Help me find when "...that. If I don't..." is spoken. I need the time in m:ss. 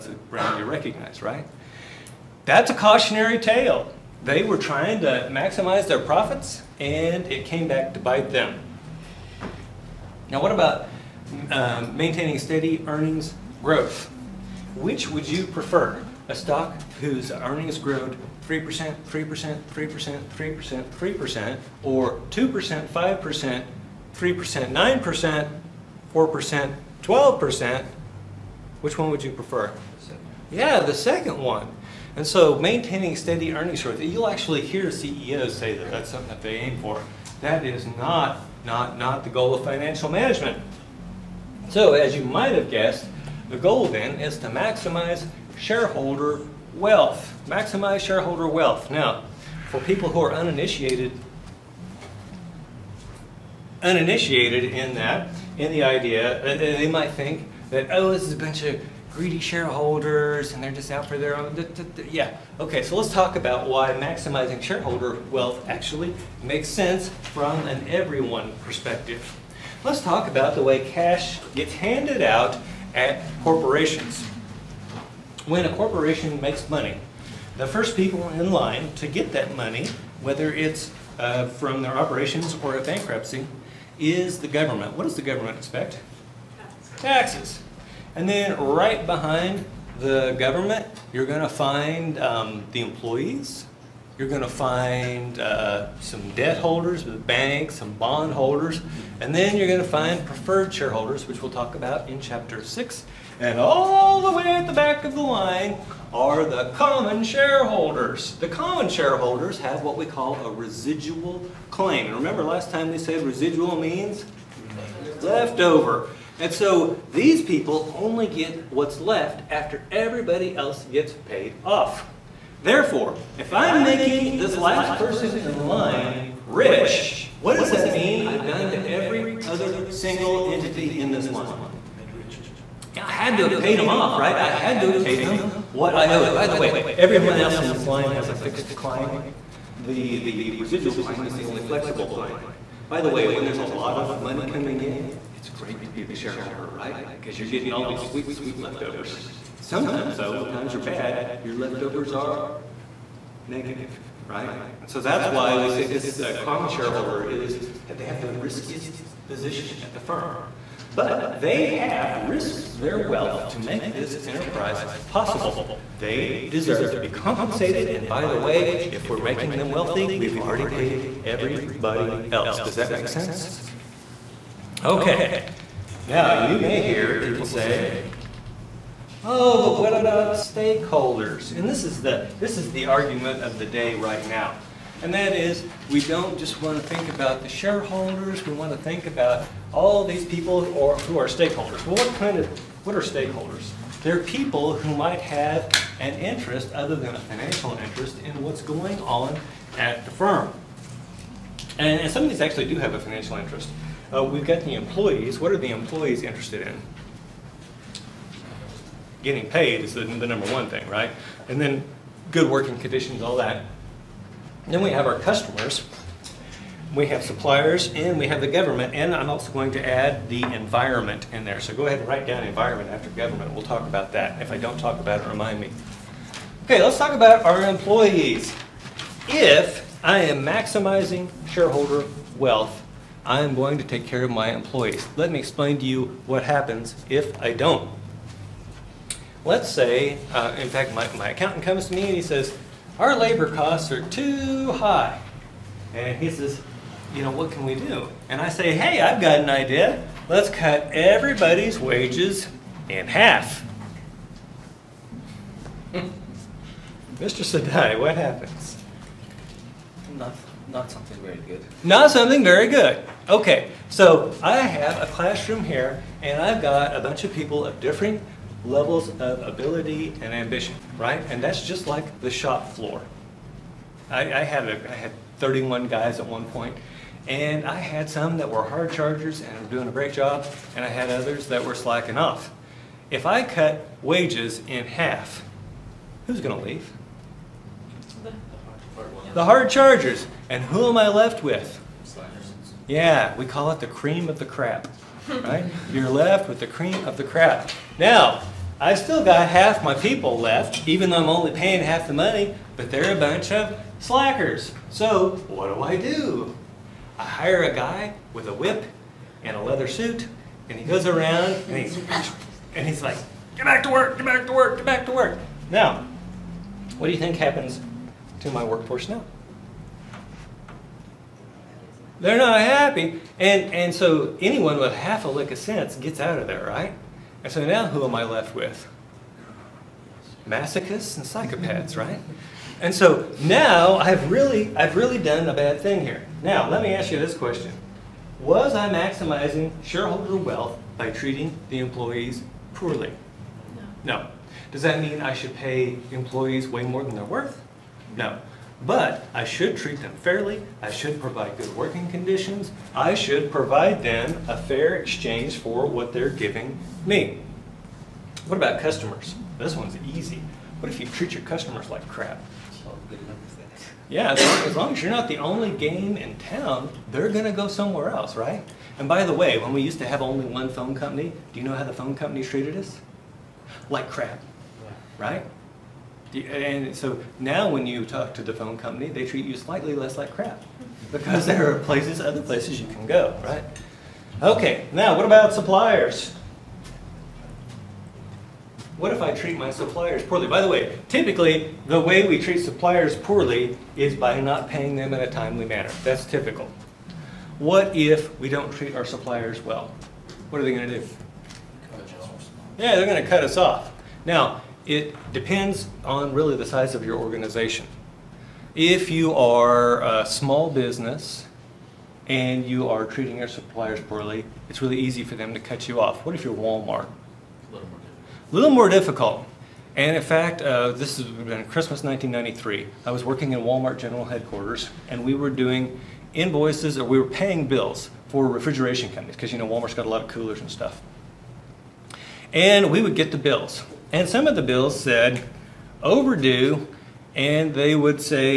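3:44.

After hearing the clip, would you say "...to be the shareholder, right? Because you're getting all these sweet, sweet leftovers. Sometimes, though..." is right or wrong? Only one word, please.
right.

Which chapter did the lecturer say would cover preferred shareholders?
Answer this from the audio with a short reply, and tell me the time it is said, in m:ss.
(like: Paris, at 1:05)
Chapter 6, at 1:42.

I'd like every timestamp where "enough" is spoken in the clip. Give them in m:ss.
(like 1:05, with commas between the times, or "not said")
not said.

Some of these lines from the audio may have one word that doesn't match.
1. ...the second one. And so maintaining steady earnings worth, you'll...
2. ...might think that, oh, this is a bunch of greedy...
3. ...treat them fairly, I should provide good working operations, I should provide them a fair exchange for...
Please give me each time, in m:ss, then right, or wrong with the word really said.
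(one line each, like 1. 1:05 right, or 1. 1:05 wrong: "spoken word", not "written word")
1. 0:30 wrong: "growth", not "worth"
2. 0:56 right
3. 5:49 wrong: "conditions", not "operations".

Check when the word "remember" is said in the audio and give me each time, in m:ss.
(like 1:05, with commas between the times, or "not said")
1:52.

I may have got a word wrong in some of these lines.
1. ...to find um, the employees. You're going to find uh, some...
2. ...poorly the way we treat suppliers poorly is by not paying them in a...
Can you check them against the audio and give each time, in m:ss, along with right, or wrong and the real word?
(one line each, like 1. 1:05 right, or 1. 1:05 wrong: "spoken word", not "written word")
1. 1:31 right
2. 6:31 wrong: "typically", not "poorly".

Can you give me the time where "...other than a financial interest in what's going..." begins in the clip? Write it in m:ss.
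3:16.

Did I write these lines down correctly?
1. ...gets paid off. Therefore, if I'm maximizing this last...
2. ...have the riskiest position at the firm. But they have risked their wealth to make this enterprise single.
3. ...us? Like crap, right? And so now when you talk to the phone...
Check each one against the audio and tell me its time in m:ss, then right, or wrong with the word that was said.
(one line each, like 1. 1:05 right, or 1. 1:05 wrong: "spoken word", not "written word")
1. 2:00 wrong: "making", not "maximizing"
2. 2:38 wrong: "possible", not "single"
3. 6:12 right.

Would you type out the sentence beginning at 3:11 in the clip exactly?
Well, what kind of, what are stakeholders?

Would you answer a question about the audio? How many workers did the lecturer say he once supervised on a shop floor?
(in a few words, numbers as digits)
31.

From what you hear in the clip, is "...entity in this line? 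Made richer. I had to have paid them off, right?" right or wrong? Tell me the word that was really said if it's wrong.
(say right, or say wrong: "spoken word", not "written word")
right.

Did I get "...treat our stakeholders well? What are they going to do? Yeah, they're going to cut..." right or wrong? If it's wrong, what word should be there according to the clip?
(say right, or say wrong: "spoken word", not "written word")
wrong: "suppliers", not "stakeholders".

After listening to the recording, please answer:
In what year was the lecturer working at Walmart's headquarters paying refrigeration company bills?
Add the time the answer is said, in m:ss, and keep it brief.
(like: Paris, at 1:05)
1993, at 7:01.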